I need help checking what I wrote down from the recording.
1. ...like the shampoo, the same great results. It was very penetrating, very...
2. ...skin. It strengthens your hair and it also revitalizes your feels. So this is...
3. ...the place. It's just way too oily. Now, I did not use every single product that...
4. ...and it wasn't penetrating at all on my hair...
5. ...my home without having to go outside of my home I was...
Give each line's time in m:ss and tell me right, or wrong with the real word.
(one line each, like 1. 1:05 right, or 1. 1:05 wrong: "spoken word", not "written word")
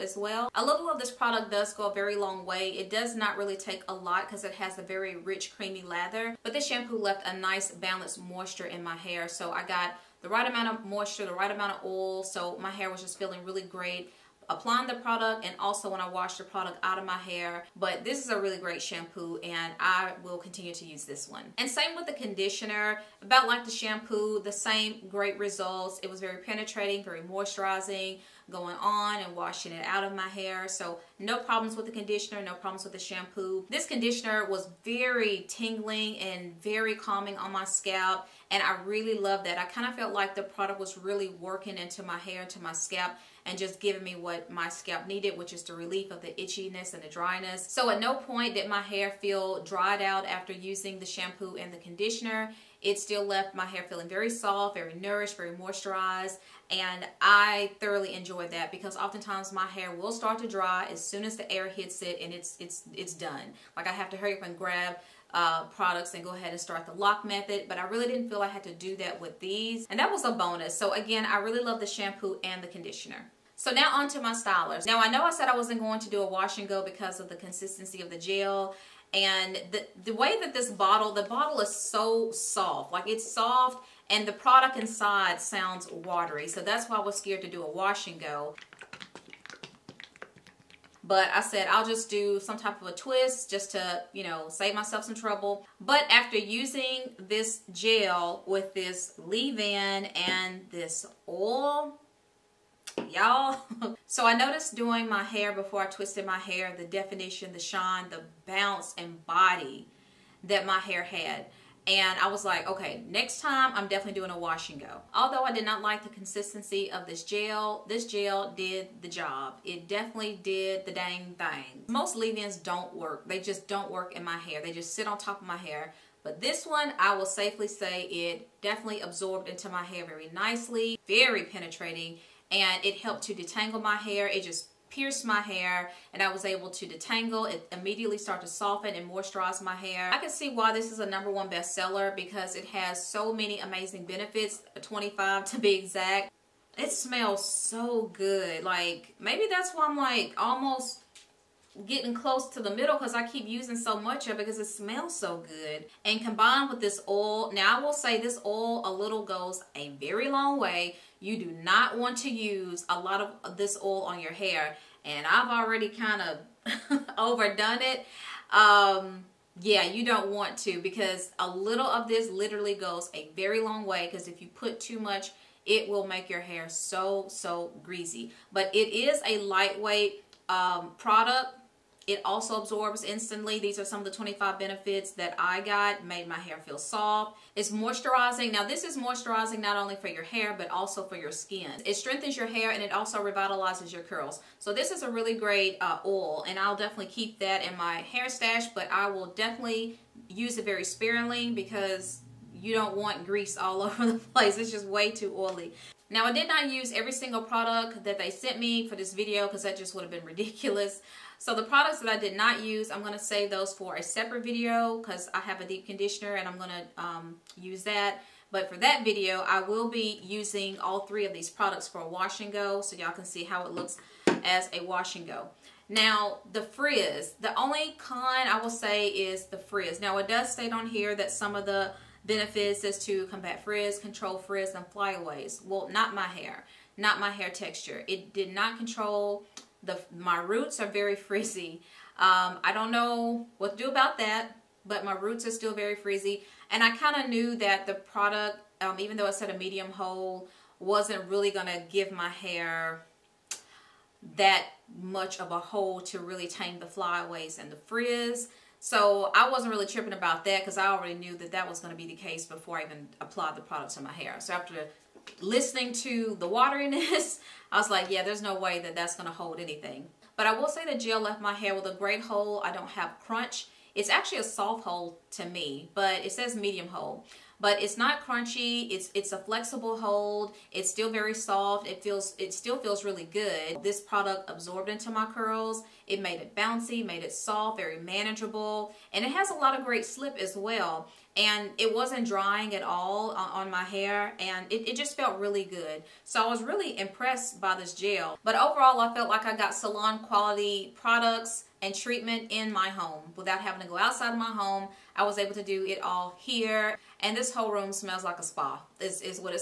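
1. 0:23 right
2. 3:11 wrong: "curls", not "feels"
3. 3:24 right
4. 4:51 wrong: "drying", not "penetrating"
5. 5:02 right.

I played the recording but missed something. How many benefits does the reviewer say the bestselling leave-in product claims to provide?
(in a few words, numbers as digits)
25.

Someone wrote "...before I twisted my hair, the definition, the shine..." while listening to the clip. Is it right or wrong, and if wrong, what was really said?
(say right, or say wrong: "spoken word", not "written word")
right.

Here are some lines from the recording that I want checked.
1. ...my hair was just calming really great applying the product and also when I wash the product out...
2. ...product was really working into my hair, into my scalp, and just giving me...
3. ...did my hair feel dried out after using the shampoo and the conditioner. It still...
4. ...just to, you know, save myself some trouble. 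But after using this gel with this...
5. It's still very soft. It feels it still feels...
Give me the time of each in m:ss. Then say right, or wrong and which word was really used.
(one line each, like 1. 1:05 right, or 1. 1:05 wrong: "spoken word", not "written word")
1. 0:12 wrong: "feeling", not "calming"
2. 0:40 right
3. 0:48 right
4. 1:33 right
5. 4:40 right.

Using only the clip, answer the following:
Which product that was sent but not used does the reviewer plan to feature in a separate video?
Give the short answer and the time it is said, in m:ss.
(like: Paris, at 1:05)
deep conditioner, at 3:35.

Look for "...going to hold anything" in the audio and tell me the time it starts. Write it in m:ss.
4:29.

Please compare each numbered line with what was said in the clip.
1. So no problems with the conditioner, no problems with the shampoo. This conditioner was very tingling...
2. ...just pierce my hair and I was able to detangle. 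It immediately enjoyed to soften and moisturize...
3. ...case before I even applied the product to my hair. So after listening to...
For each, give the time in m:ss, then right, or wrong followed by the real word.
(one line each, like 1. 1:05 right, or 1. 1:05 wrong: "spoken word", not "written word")
1. 0:30 right
2. 2:14 wrong: "started", not "enjoyed"
3. 4:22 right.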